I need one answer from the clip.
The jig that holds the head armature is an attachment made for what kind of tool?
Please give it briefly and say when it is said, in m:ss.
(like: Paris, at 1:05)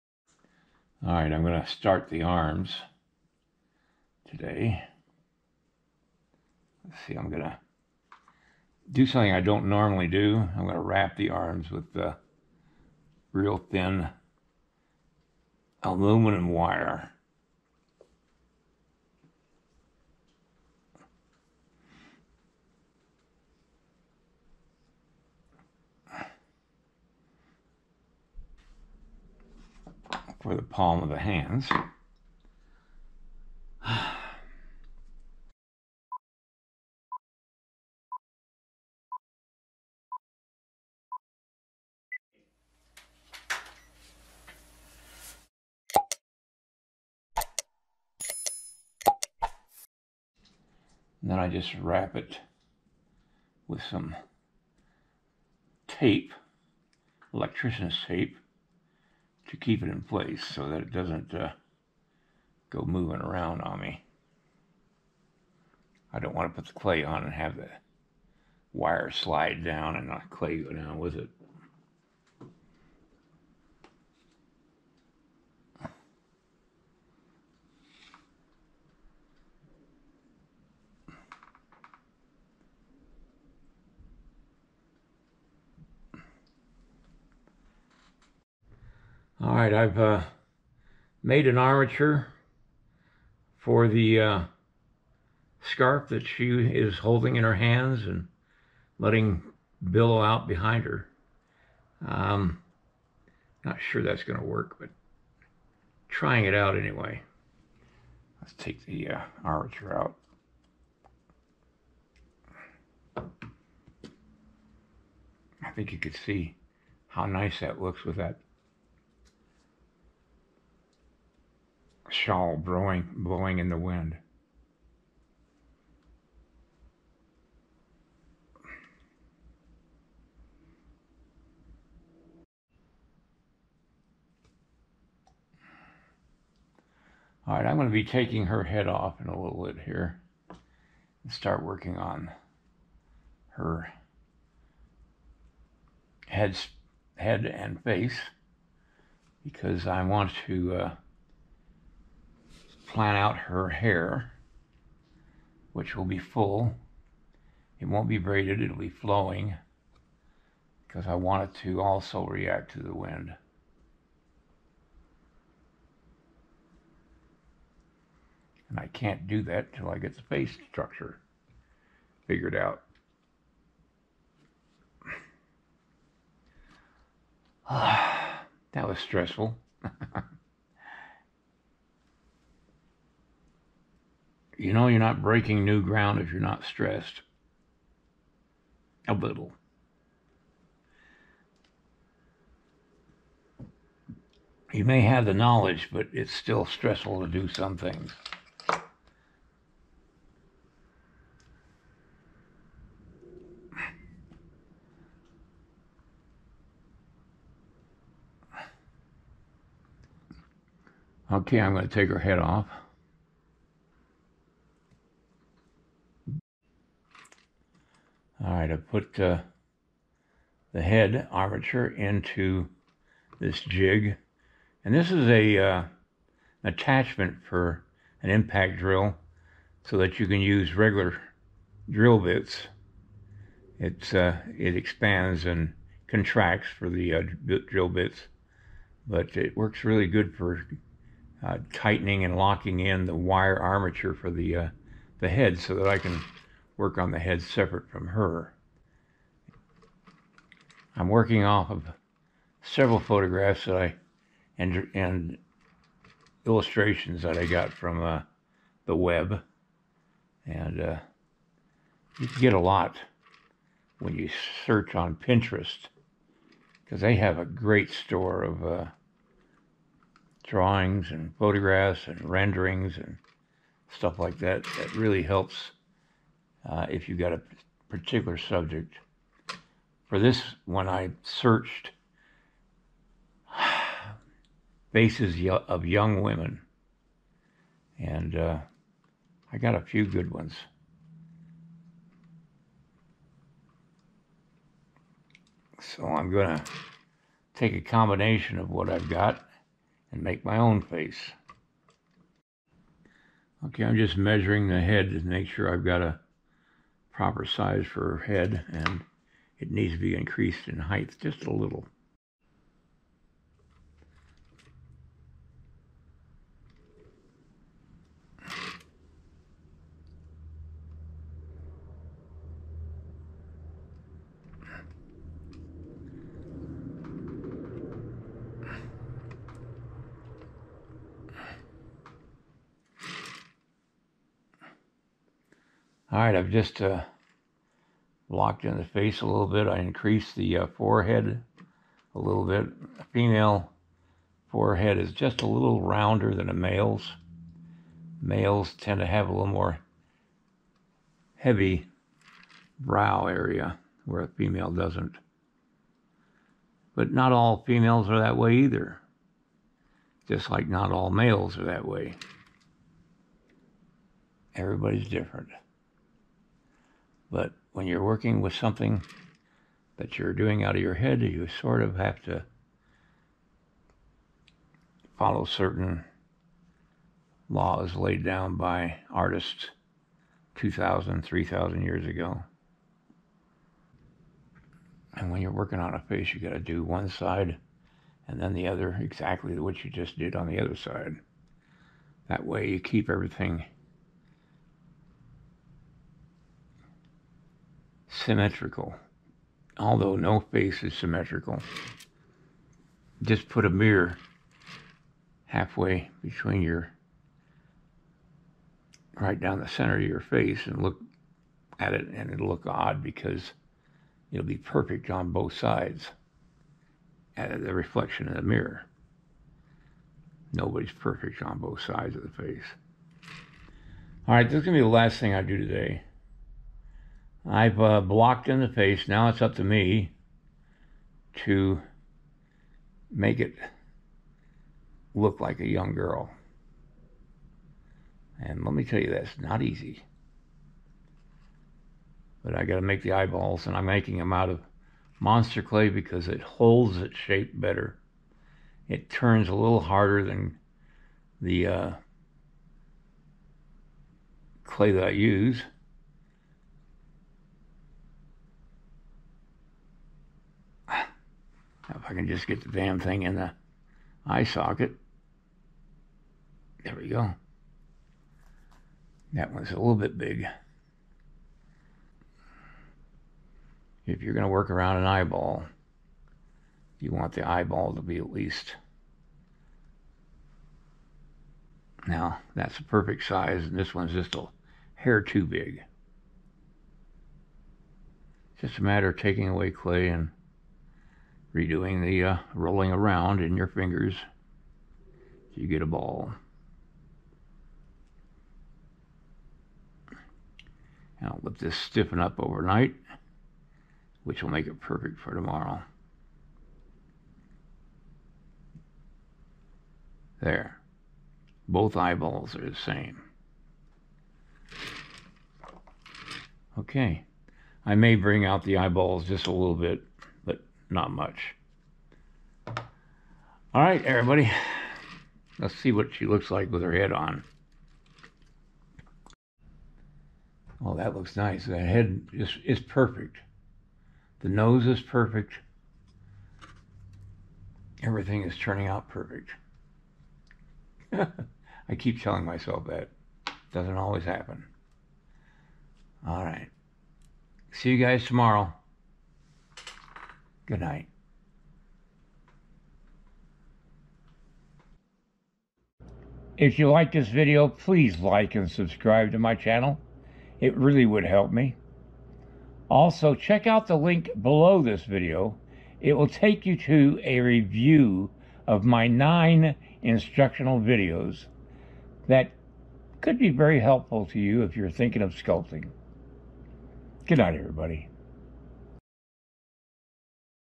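impact drill, at 3:48.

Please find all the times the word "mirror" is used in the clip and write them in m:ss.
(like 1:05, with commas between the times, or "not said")
6:43, 6:58.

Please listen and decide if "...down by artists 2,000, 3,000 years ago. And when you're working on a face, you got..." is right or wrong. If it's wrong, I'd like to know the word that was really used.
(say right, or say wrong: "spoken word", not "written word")
right.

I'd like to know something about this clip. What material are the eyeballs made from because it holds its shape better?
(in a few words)
monster clay.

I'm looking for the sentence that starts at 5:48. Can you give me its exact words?
Males tend to have a little more heavy brow area where a female doesn't.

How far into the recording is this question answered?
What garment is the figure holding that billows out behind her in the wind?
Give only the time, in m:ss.
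1:35.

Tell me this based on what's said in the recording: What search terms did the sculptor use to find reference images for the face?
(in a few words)
faces of young women.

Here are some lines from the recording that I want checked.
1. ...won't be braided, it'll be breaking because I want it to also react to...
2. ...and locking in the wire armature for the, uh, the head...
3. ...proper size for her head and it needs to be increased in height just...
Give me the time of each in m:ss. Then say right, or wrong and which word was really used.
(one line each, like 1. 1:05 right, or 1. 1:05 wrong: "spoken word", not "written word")
1. 2:37 wrong: "flowing", not "breaking"
2. 4:02 right
3. 5:07 right.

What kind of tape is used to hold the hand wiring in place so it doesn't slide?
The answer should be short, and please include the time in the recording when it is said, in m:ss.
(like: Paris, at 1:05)
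electrician's tape, at 0:57.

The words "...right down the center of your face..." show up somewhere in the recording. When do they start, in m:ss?
6:49.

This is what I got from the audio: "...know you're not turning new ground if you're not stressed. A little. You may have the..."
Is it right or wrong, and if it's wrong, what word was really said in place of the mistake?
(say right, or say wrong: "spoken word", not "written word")
wrong: "breaking", not "turning".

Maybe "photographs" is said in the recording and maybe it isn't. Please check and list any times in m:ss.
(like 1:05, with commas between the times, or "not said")
4:12, 4:31.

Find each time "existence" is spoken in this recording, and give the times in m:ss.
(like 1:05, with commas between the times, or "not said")
not said.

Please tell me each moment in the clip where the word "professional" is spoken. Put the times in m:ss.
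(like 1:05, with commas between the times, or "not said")
not said.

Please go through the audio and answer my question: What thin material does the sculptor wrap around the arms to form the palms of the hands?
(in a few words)
aluminum wire.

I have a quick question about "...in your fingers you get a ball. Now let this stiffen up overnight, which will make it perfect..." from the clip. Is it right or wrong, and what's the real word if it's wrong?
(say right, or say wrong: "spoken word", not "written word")
right.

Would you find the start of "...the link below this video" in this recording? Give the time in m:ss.
9:23.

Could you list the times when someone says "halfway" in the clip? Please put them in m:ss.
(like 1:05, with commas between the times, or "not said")
6:45.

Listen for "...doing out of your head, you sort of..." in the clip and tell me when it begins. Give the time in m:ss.
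6:10.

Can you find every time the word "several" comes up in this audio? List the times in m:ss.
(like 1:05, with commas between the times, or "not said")
4:12.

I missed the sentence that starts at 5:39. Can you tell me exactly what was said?
I increased the uh, forehead a little bit.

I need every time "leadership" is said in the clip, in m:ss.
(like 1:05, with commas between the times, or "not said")
not said.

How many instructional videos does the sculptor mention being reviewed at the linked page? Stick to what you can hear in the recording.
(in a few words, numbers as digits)
9.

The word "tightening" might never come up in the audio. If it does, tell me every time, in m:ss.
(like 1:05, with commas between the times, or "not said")
4:01.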